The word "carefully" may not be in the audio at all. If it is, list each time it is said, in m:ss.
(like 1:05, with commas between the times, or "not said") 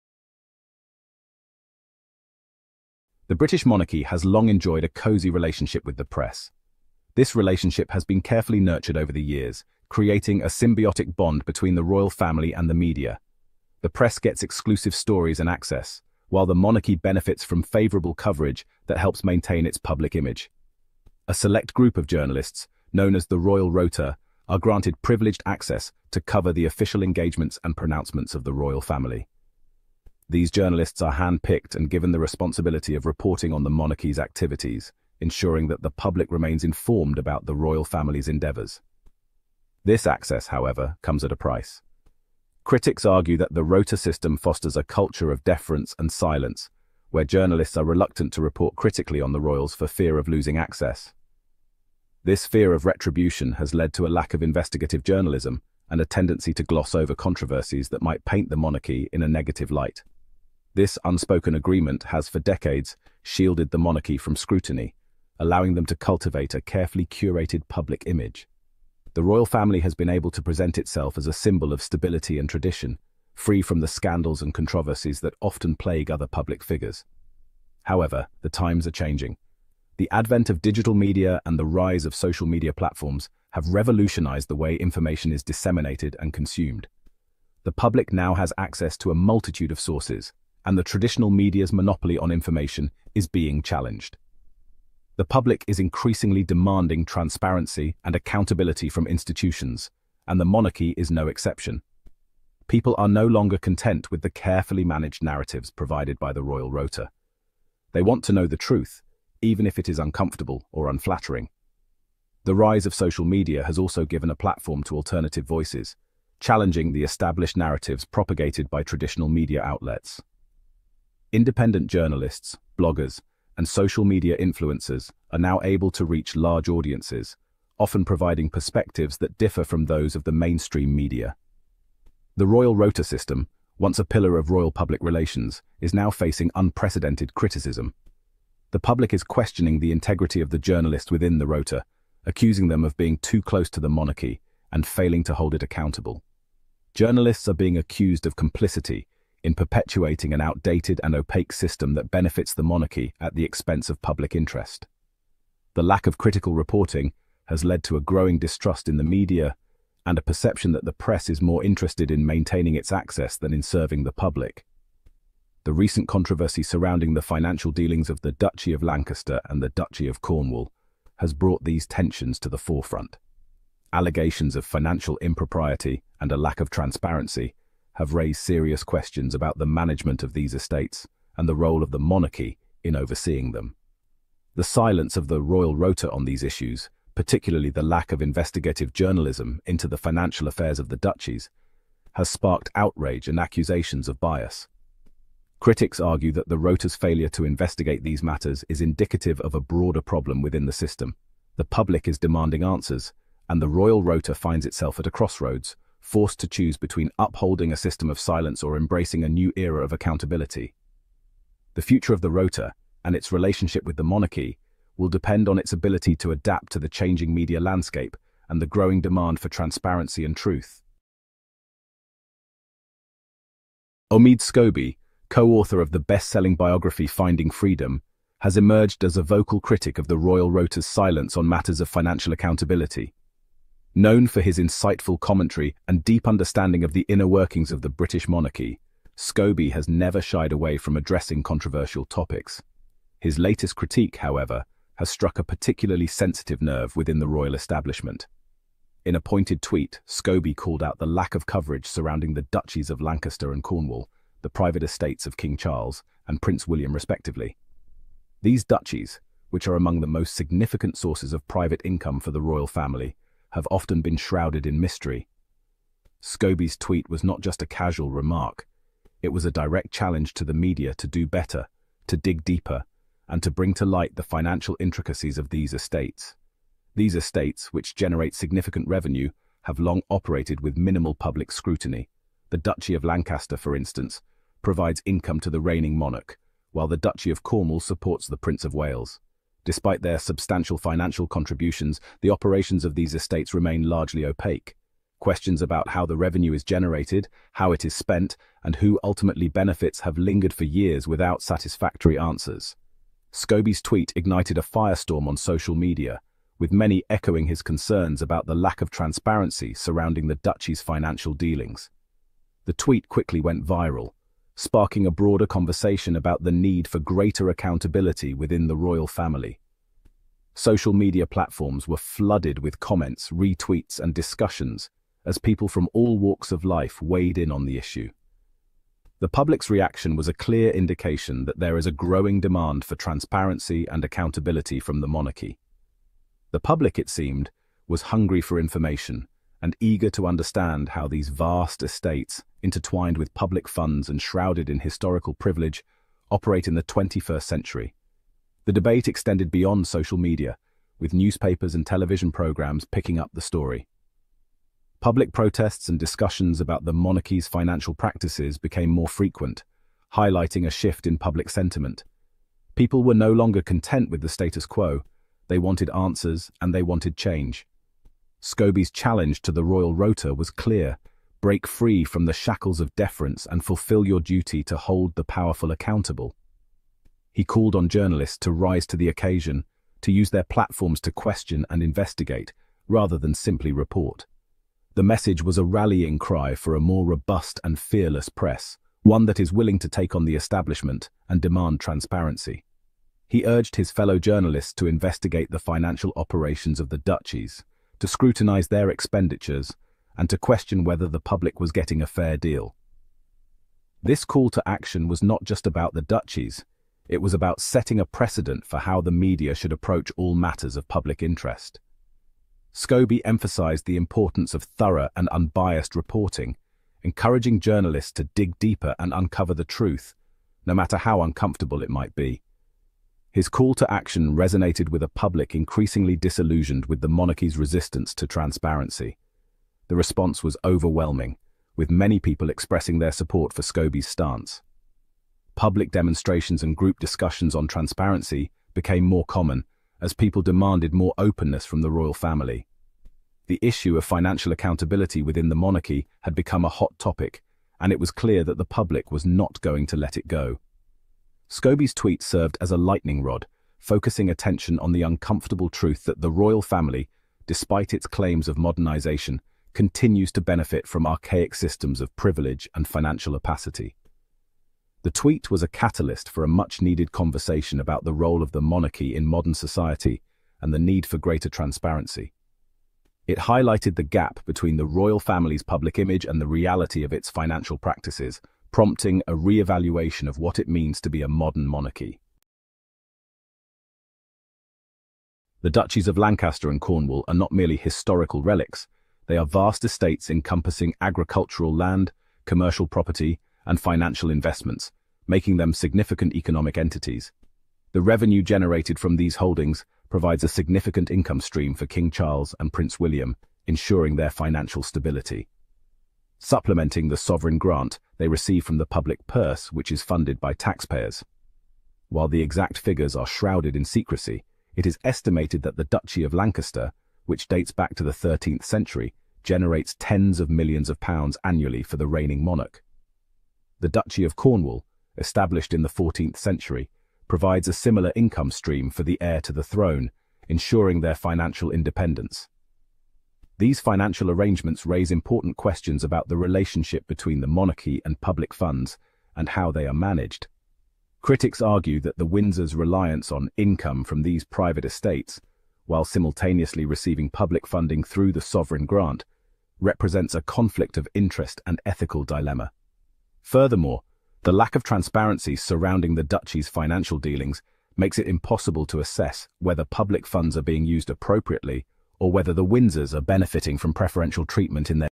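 0:08, 1:06, 1:44.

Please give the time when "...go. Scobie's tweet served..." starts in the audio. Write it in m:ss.
7:30.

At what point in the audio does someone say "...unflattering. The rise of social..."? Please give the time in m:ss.
1:50.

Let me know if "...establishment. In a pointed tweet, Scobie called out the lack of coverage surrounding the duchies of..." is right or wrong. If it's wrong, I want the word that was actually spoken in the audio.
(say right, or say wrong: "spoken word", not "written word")
right.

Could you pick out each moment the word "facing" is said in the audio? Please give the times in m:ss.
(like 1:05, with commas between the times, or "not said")
2:16.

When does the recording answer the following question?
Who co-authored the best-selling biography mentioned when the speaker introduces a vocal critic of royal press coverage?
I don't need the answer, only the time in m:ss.
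3:44.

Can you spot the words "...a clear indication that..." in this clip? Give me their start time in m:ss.
5:30.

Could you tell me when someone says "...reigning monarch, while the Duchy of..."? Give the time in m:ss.
4:45.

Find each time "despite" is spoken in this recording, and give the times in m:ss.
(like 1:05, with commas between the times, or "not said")
4:49, 7:37.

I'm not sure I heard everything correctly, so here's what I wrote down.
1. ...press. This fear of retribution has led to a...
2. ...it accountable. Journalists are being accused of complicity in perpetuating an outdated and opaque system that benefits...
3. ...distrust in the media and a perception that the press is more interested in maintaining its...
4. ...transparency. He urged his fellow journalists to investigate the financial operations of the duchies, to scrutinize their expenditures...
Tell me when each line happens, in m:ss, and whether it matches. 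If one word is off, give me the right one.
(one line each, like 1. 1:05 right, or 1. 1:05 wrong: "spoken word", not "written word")
1. 0:50 wrong: "access", not "press"
2. 2:25 right
3. 2:38 right
4. 6:31 right.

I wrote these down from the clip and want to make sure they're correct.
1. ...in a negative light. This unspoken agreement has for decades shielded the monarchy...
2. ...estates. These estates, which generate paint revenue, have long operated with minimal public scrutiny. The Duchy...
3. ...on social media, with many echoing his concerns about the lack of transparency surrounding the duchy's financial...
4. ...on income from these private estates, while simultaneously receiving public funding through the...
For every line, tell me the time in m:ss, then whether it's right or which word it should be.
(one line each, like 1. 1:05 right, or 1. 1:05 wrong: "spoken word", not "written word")
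1. 0:59 right
2. 4:35 wrong: "significant", not "paint"
3. 5:05 right
4. 9:03 right.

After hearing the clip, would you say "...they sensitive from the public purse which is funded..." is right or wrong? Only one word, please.
wrong.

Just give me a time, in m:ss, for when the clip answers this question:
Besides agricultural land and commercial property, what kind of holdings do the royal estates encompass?
8:13.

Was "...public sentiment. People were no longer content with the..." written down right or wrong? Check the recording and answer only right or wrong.
right.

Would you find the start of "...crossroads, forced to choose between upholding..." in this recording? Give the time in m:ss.
3:25.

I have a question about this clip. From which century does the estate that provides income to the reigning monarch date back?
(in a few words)
13th century.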